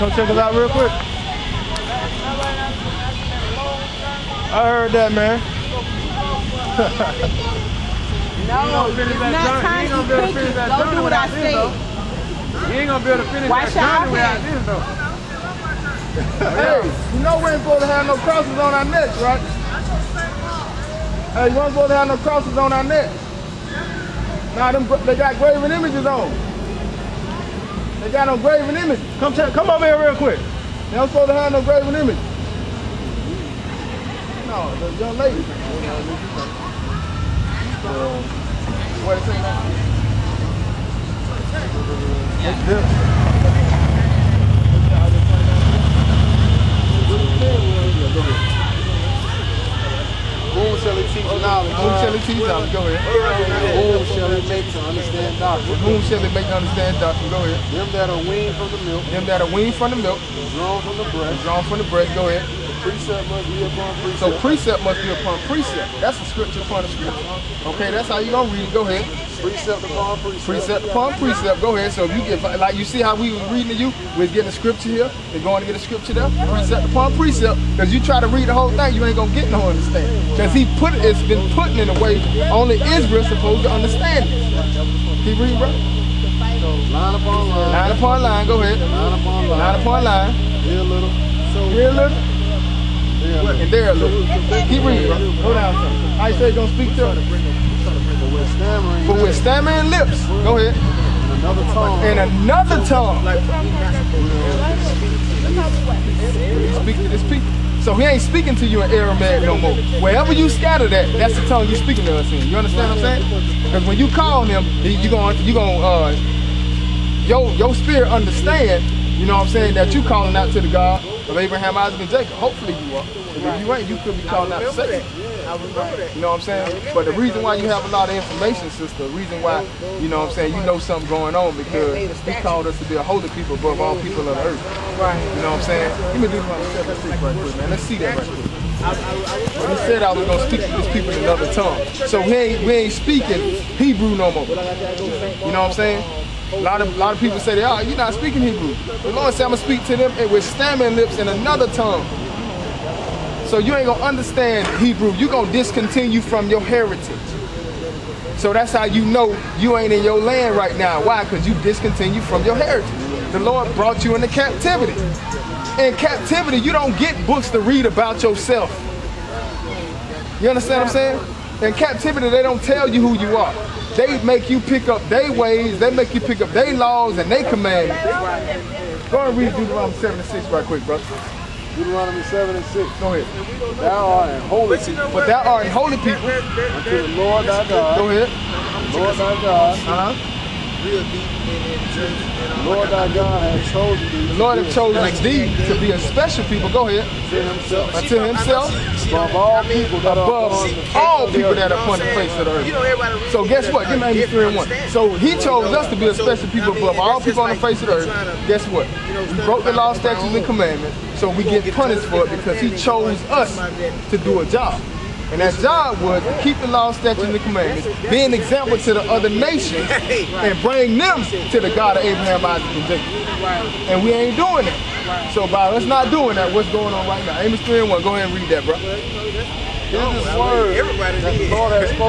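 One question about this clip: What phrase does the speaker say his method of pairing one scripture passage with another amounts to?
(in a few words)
A scripture upon a scripture.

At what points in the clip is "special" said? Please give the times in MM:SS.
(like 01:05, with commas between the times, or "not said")
03:15, 03:26.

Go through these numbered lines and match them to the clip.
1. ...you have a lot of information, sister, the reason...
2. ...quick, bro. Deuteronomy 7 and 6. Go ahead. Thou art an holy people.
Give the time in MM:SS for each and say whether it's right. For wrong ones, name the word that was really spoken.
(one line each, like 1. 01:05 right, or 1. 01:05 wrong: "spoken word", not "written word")
1. 02:07 right
2. 03:00 right.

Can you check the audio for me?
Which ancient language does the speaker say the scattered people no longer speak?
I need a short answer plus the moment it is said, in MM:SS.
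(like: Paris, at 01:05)
Aramaic, at 01:48.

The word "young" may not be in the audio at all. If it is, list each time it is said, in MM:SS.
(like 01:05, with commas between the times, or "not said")
00:34.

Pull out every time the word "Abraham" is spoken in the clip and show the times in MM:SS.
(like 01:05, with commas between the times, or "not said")
02:01, 03:42.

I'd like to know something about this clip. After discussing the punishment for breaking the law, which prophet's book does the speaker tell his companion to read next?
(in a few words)
Amos.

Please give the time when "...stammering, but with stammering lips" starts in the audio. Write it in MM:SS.
01:38.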